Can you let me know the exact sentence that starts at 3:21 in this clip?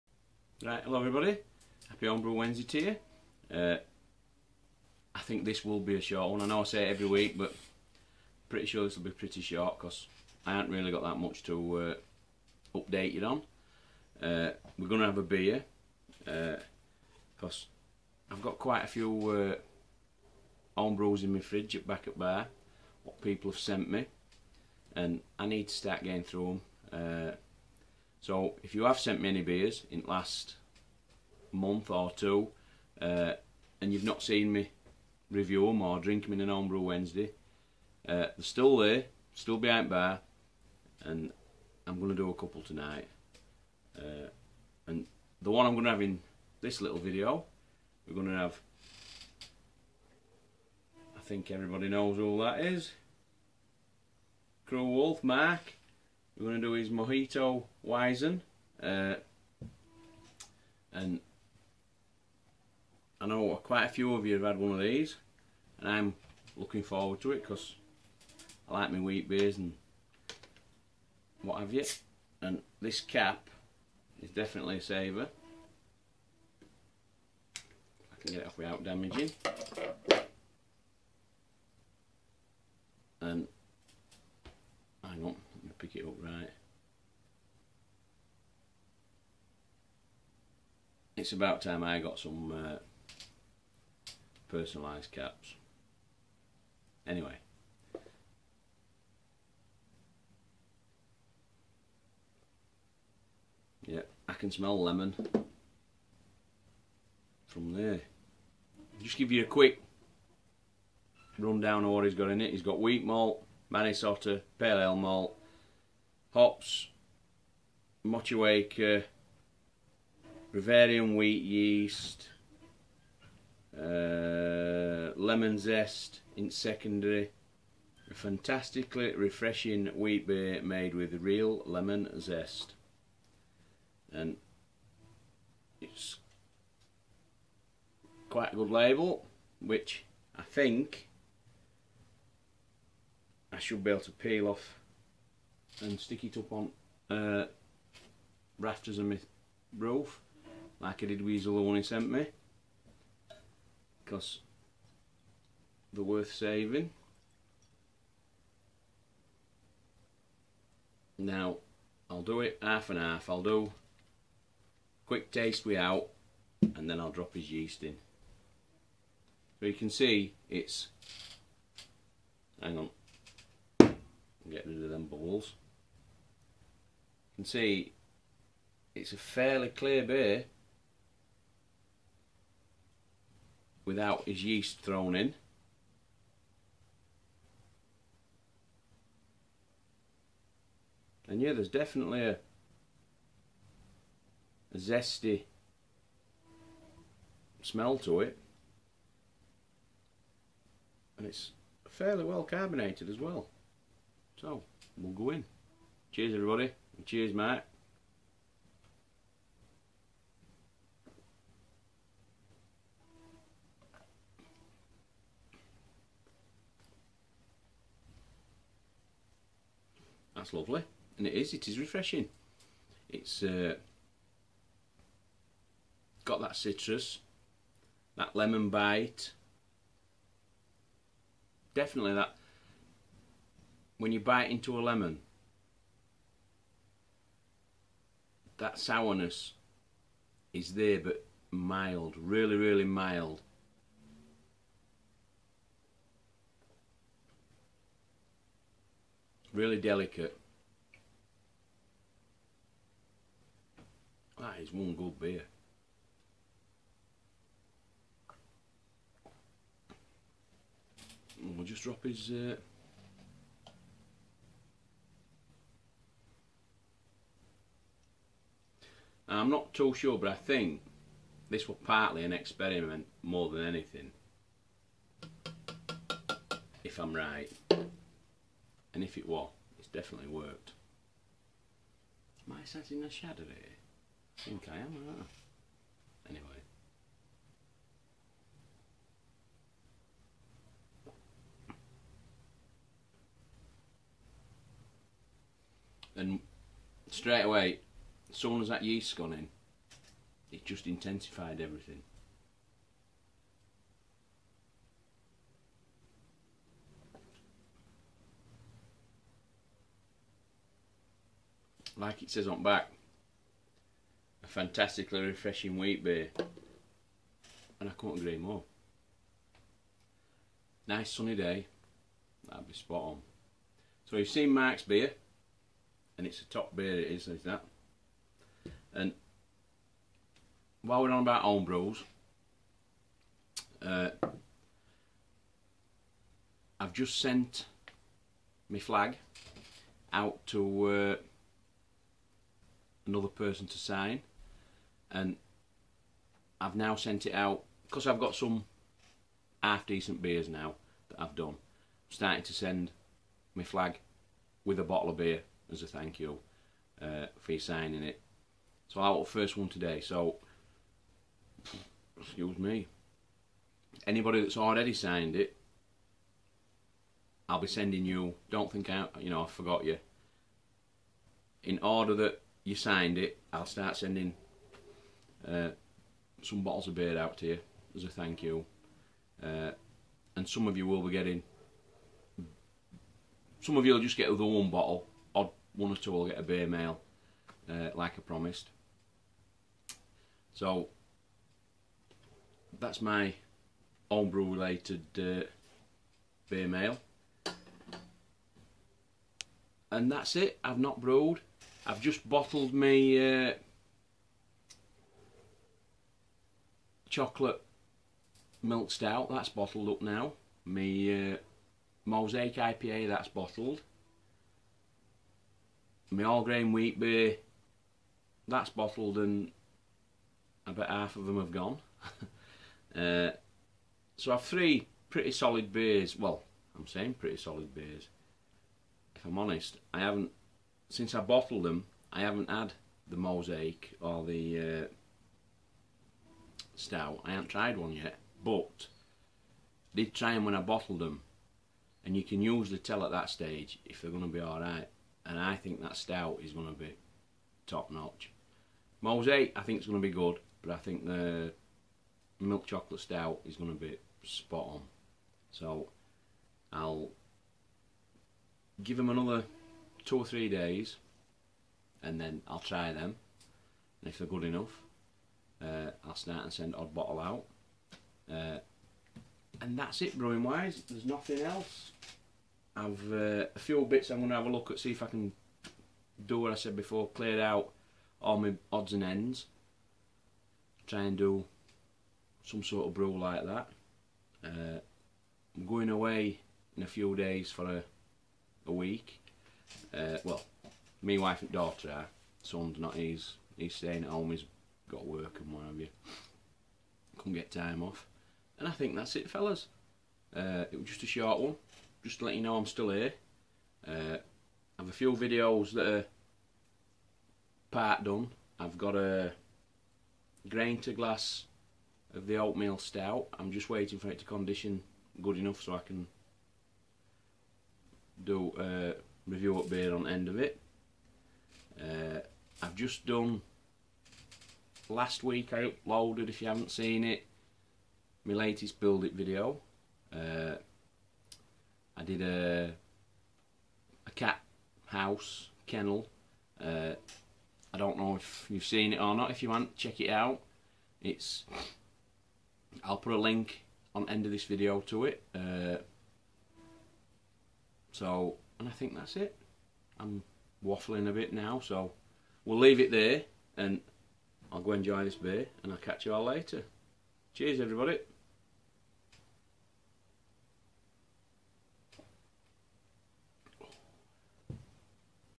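And it's fairly well carbonated as well.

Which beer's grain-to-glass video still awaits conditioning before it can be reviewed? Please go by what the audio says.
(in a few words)
Oatmeal stout.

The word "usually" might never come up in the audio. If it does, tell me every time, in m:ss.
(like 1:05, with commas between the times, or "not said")
7:22.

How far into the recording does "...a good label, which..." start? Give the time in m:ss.
2:18.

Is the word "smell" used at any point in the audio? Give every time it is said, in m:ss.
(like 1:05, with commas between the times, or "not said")
1:44, 3:17.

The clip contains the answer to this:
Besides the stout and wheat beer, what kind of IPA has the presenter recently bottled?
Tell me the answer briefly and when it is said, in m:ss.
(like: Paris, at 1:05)
Mosaic IPA, at 6:52.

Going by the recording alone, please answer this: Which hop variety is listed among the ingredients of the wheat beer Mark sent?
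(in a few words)
Motueka.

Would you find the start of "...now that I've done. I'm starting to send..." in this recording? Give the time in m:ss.
5:50.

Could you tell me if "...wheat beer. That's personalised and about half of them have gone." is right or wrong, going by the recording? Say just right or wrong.
wrong.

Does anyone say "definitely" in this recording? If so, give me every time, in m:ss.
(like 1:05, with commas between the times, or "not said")
1:14, 3:11, 3:51, 4:39.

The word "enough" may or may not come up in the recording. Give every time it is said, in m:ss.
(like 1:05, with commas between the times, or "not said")
7:44, 8:35.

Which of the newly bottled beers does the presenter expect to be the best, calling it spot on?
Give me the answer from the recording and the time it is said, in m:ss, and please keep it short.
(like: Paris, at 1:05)
Milk chocolate stout, at 7:32.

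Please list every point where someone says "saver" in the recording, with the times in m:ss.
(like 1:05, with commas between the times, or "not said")
1:14.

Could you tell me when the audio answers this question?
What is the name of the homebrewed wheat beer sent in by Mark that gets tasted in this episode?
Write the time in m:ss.
0:56.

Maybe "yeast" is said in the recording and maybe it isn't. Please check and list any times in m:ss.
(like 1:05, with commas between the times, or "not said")
2:01, 2:47, 3:04, 4:58.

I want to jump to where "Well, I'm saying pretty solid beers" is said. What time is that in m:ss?
7:06.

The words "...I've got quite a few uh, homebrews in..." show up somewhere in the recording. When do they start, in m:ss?
0:18.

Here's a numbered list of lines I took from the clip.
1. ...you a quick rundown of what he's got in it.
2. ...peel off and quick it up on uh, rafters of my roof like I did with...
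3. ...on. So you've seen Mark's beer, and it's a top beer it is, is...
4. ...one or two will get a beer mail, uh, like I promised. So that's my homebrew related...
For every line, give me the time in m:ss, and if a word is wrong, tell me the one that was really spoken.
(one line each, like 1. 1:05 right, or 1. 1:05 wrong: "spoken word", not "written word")
1. 1:49 right
2. 2:24 wrong: "stick", not "quick"
3. 5:23 right
4. 6:25 right.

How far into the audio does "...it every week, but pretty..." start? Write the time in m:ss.
0:06.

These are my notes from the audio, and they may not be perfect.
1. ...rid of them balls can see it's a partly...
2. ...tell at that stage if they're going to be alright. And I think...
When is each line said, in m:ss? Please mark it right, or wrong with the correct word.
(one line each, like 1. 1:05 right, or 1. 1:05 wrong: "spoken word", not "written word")
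1. 2:54 wrong: "fairly", not "partly"
2. 7:22 right.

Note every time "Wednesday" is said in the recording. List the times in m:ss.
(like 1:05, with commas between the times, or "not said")
0:02, 0:36.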